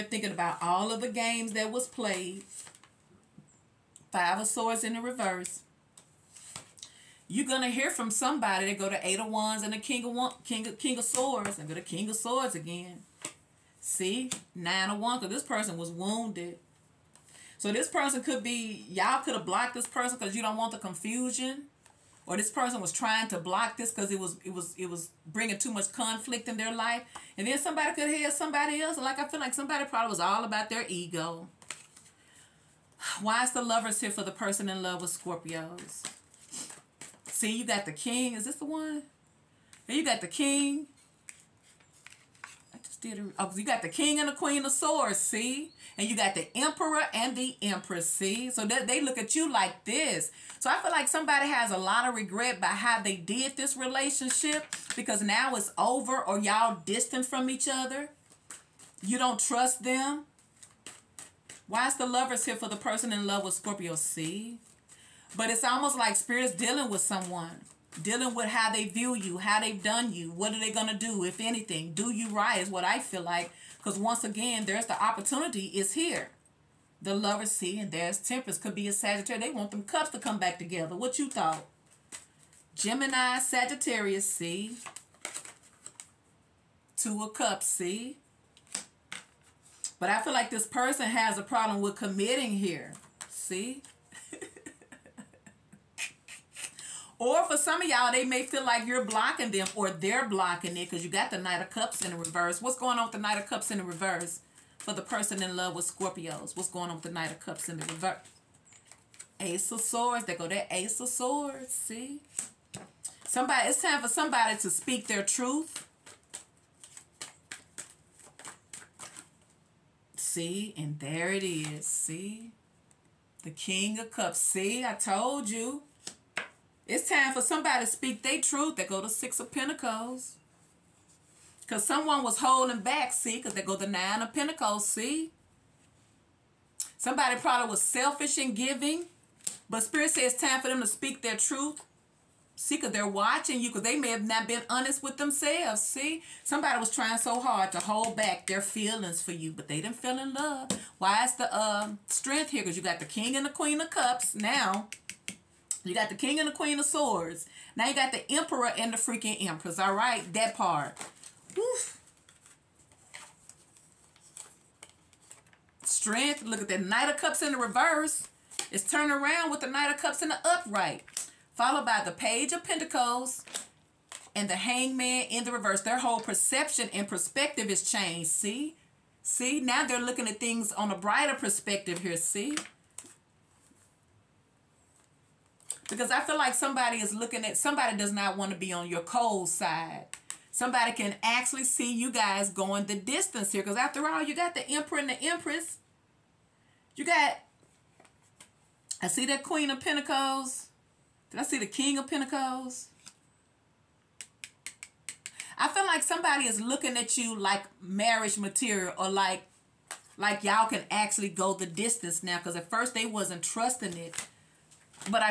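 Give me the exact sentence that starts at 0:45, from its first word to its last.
And you got the emperor and the empress, see?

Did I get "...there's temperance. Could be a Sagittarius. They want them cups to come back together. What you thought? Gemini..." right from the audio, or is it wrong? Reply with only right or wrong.
right.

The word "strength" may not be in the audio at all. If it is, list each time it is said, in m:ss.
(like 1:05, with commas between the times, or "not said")
2:32, 2:45.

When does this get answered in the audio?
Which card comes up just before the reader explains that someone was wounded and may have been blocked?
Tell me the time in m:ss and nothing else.
0:14.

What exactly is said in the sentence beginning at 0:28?
like I feel like somebody probably was all about their ego.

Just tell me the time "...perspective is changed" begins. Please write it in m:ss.
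2:57.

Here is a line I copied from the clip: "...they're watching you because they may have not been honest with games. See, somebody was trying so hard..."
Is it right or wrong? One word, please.
wrong.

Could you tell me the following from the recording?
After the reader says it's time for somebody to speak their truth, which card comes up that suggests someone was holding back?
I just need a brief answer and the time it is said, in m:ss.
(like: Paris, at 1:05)
Six of Pentacles, at 2:09.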